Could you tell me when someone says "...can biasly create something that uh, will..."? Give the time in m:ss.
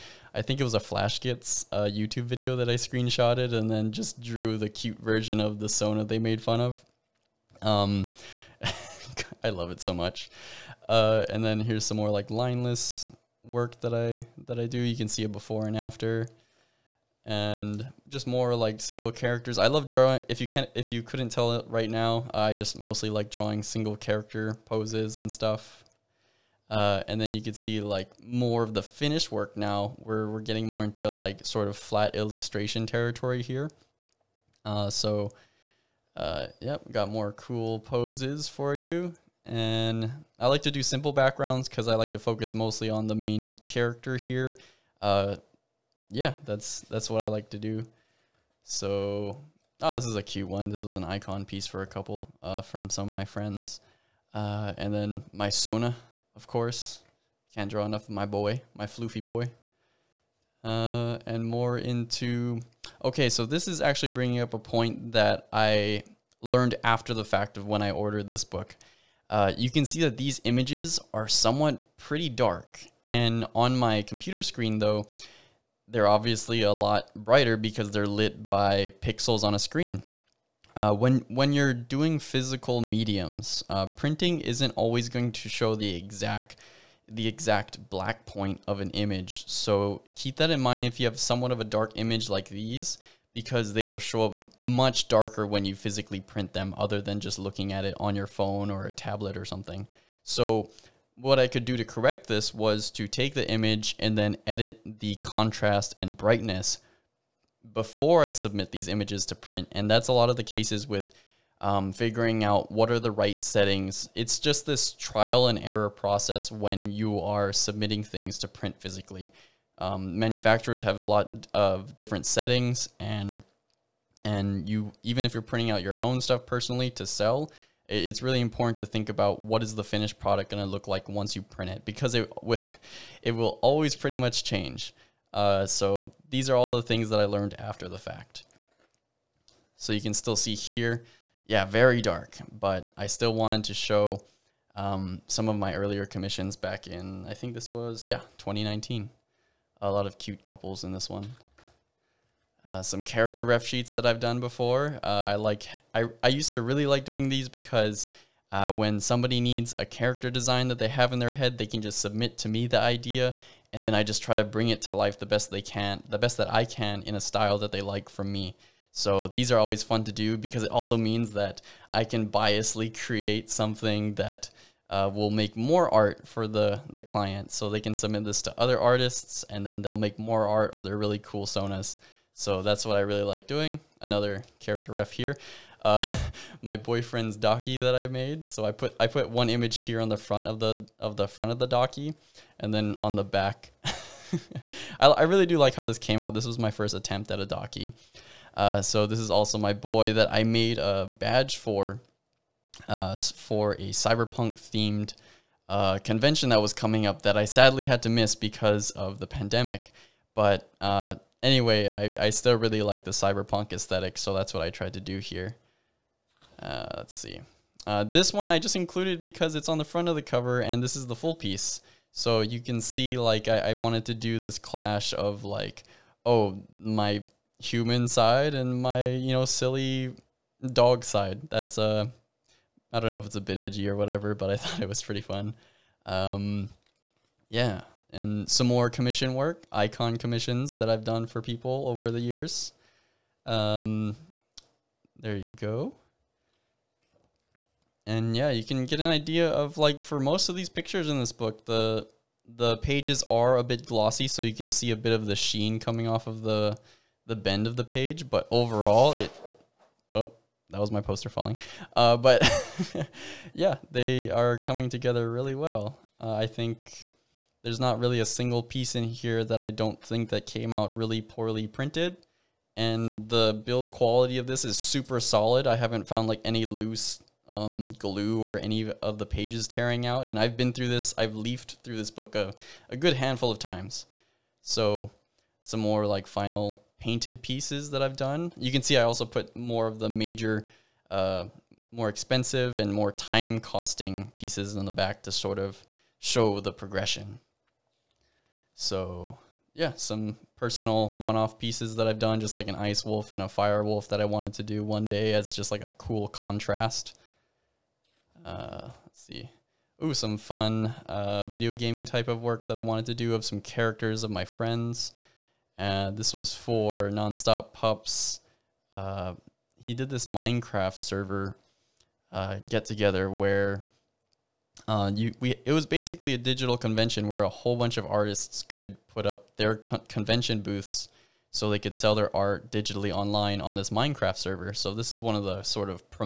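2:52.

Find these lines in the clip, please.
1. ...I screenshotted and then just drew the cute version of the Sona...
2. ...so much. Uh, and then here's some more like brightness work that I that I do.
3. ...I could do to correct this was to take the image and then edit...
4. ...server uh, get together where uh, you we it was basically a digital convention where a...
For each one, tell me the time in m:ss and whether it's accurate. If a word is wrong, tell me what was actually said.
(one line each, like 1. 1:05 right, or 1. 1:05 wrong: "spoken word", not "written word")
1. 0:02 right
2. 0:09 wrong: "lineless", not "brightness"
3. 1:41 right
4. 5:20 right.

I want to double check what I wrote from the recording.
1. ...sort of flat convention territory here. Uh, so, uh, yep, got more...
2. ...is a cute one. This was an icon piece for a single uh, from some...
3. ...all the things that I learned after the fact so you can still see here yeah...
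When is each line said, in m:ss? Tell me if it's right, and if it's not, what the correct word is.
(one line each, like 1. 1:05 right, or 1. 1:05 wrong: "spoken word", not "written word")
1. 0:31 wrong: "illustration", not "convention"
2. 0:50 wrong: "couple", not "single"
3. 2:16 right.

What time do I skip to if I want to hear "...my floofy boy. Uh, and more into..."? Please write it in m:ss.
0:58.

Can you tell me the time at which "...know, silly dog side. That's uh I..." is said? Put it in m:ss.
3:49.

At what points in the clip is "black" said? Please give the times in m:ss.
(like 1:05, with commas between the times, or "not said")
1:27.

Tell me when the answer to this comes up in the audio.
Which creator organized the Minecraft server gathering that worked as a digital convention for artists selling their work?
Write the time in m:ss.
5:17.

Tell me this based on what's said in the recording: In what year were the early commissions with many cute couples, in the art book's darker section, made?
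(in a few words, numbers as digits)
2019.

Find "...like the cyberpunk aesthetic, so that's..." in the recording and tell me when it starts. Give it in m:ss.
3:32.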